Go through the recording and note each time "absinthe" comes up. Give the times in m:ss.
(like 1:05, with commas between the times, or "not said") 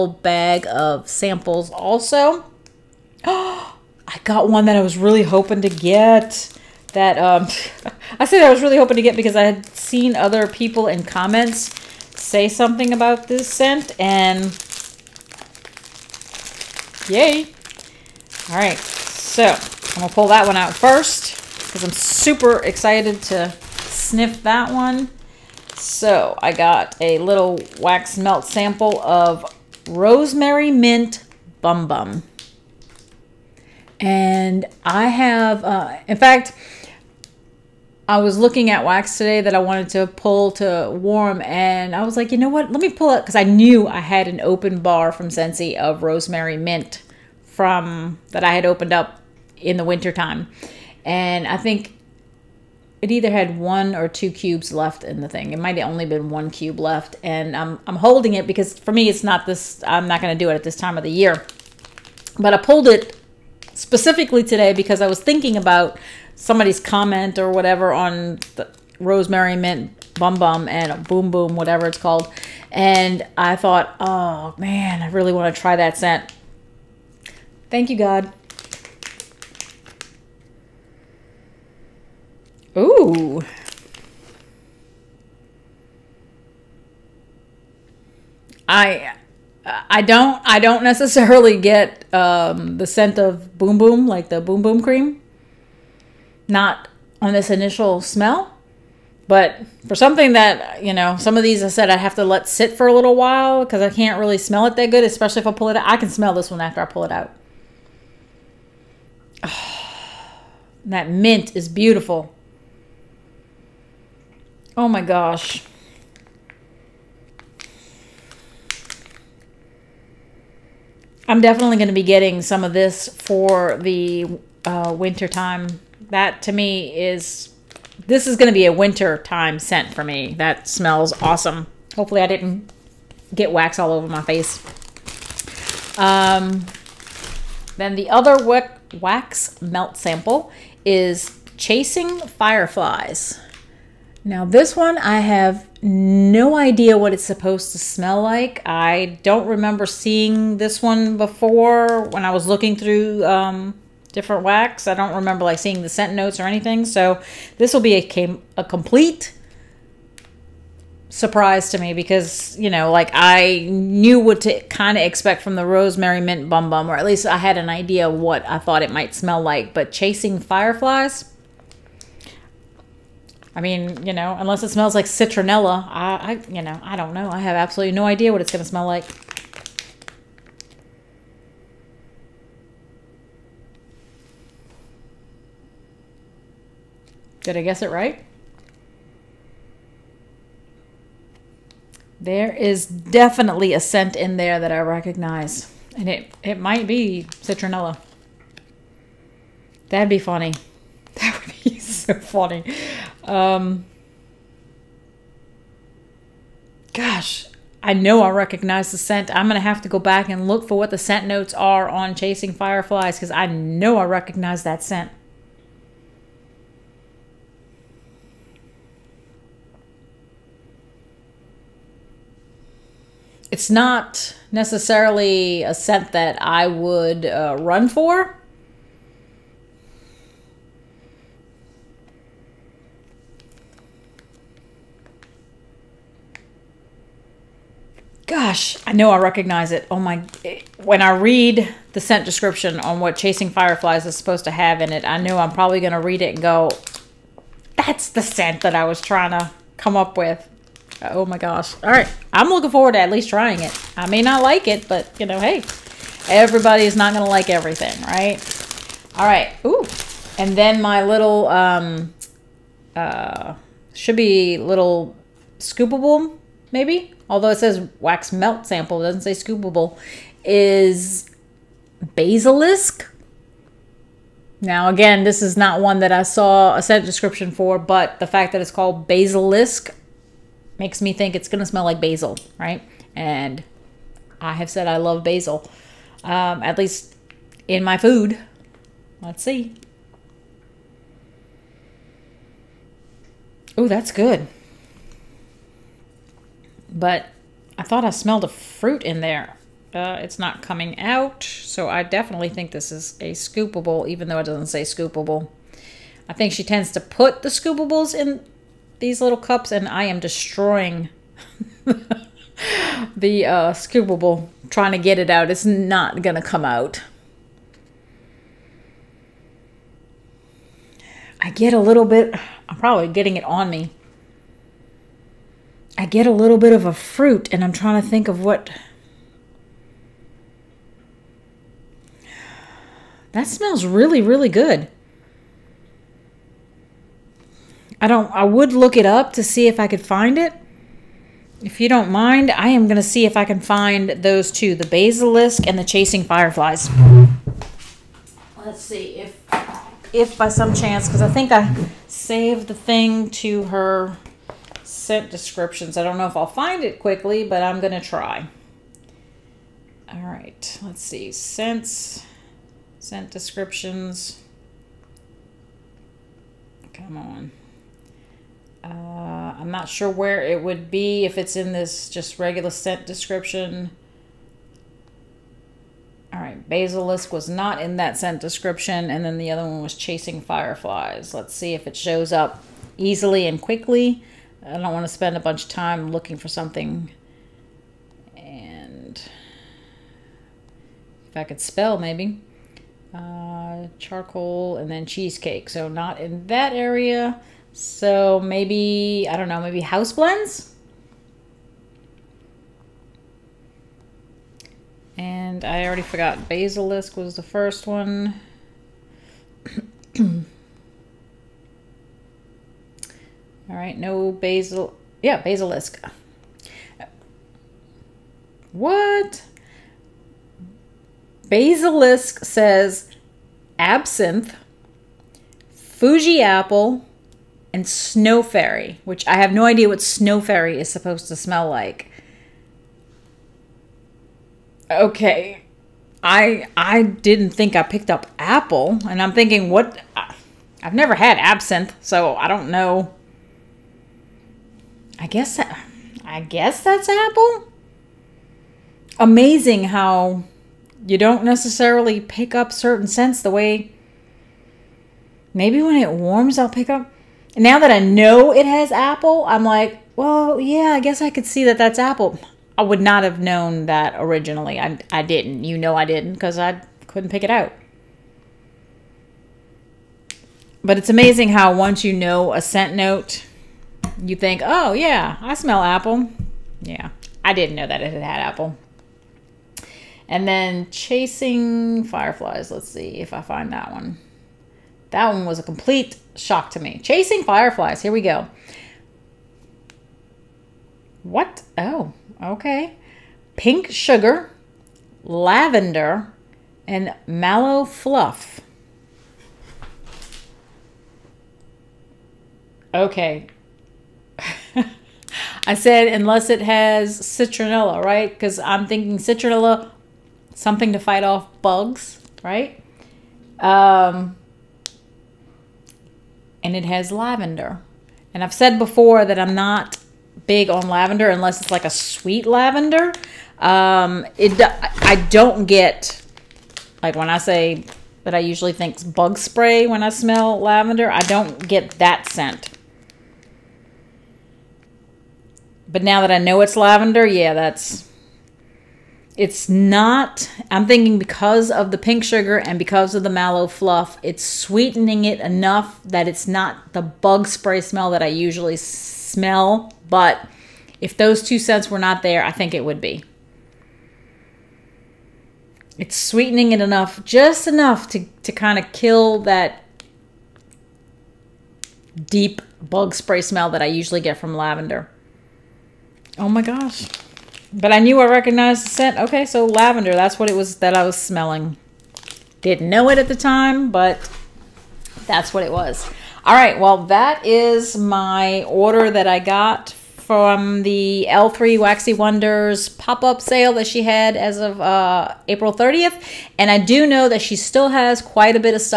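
7:03, 7:21.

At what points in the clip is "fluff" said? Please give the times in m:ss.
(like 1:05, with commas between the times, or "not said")
8:17, 9:03.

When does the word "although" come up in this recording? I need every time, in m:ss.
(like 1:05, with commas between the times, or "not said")
4:27.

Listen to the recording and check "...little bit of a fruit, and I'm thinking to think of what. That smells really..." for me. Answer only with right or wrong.
wrong.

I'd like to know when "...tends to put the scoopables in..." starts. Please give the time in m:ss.
5:06.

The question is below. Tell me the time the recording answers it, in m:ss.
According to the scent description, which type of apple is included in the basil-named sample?
7:05.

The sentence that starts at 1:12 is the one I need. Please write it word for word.
And I thought, oh man, I really want to try that scent.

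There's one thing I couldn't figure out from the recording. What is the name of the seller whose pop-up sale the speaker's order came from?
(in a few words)
L3 Waxy Wonders.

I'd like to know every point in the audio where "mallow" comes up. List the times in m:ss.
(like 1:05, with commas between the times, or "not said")
8:17, 9:03.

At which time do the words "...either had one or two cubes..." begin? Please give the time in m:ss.
0:53.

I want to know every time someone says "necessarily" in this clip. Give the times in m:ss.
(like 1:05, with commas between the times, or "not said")
1:30, 3:44, 7:31.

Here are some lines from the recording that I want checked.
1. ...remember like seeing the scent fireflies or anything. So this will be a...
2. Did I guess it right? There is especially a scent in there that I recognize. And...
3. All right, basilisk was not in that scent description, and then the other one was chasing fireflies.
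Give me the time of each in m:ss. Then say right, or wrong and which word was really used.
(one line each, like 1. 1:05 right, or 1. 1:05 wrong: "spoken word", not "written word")
1. 2:35 wrong: "notes", not "fireflies"
2. 3:07 wrong: "definitely", not "especially"
3. 6:16 right.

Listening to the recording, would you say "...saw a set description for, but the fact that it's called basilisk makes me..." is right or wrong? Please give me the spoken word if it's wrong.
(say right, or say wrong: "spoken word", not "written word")
right.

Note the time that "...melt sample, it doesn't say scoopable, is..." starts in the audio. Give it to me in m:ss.
4:28.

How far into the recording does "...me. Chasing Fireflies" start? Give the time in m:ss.
8:06.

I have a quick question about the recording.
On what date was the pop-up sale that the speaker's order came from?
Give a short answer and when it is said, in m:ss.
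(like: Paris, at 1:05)
April 30th, at 9:45.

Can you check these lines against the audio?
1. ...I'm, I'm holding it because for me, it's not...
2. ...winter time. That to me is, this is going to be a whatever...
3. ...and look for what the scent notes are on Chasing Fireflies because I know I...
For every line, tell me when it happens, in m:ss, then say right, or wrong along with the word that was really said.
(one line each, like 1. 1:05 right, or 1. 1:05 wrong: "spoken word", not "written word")
1. 0:57 right
2. 2:04 wrong: "winter", not "whatever"
3. 3:30 right.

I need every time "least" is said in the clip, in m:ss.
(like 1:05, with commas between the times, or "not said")
2:47, 4:13, 4:46.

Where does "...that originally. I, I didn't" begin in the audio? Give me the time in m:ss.
7:43.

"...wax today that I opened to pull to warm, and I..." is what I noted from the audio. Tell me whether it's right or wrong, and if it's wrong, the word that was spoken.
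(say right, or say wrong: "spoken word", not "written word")
wrong: "wanted", not "opened".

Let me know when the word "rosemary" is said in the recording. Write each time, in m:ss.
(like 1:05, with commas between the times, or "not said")
0:29, 0:46, 1:08, 2:45.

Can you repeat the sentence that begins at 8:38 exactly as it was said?
And I've said before that I'm not big on lavender unless it's like a sweet lavender.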